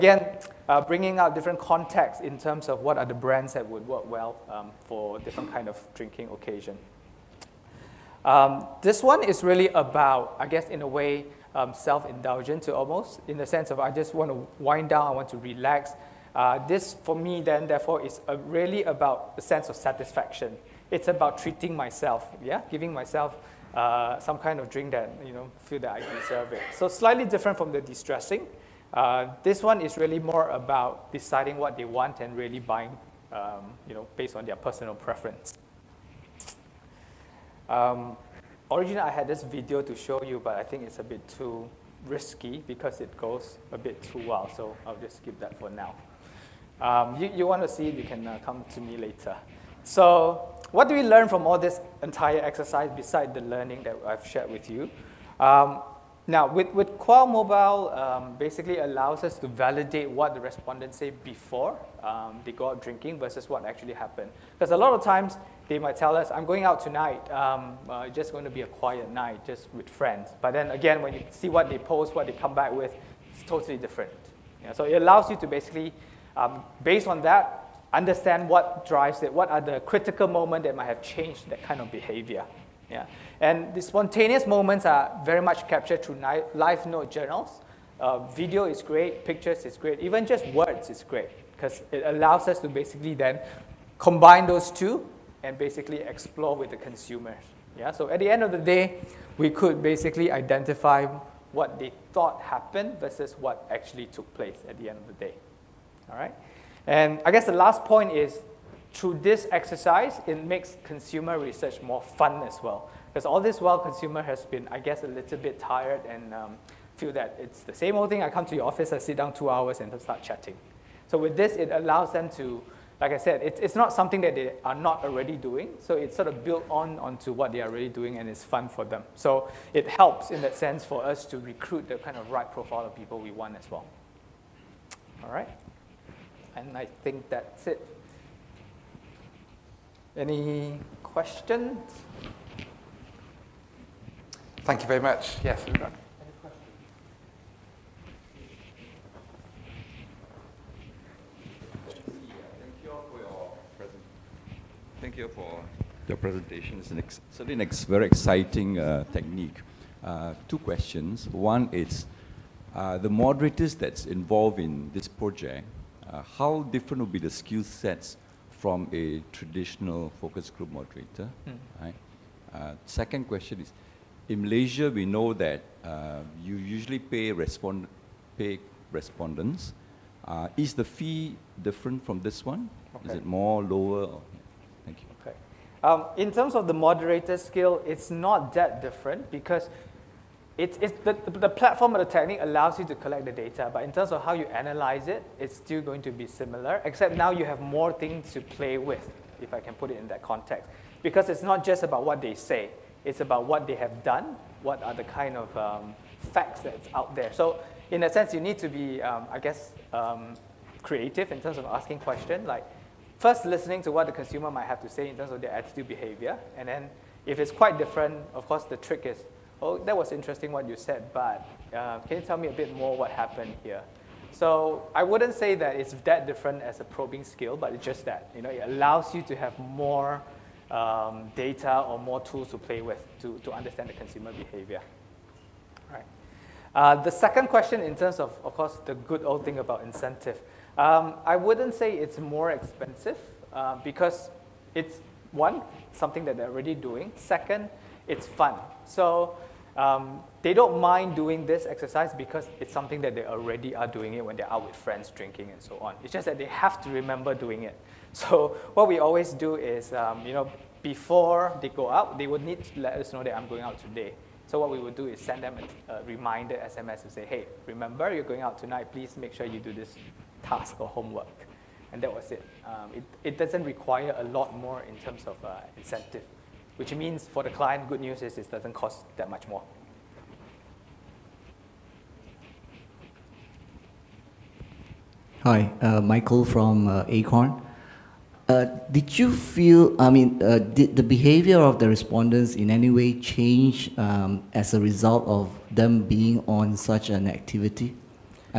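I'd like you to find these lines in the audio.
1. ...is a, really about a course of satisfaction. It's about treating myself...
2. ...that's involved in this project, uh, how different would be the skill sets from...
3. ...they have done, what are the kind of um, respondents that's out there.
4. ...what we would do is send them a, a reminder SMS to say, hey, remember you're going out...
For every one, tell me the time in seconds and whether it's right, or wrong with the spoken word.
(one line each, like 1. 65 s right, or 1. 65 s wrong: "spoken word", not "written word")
1. 18 s wrong: "sense", not "course"
2. 163 s right
3. 203 s wrong: "facts", not "respondents"
4. 264 s right.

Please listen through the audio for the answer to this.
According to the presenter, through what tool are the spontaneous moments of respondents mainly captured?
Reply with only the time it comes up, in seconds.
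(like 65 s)
86 s.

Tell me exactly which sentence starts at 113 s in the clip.
Because all this while, consumer has been, I guess, a little bit tired and um, feel that it's the same old thing.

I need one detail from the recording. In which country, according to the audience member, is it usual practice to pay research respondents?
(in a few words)
Malaysia.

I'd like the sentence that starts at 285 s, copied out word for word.
Hi, uh, Michael from uh, Acorn.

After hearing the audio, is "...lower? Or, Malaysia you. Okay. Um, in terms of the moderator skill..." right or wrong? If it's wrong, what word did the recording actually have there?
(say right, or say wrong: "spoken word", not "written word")
wrong: "Thank", not "Malaysia".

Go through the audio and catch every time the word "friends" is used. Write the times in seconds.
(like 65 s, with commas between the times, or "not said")
69 s, 254 s.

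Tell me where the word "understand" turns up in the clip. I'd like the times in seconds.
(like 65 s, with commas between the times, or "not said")
77 s, 233 s.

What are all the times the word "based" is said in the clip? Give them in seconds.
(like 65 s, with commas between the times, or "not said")
34 s, 76 s.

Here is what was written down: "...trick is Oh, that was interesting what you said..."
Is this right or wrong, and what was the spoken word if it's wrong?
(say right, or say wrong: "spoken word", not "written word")
right.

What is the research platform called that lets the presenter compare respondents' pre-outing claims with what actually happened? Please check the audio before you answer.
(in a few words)
Qual Mobile.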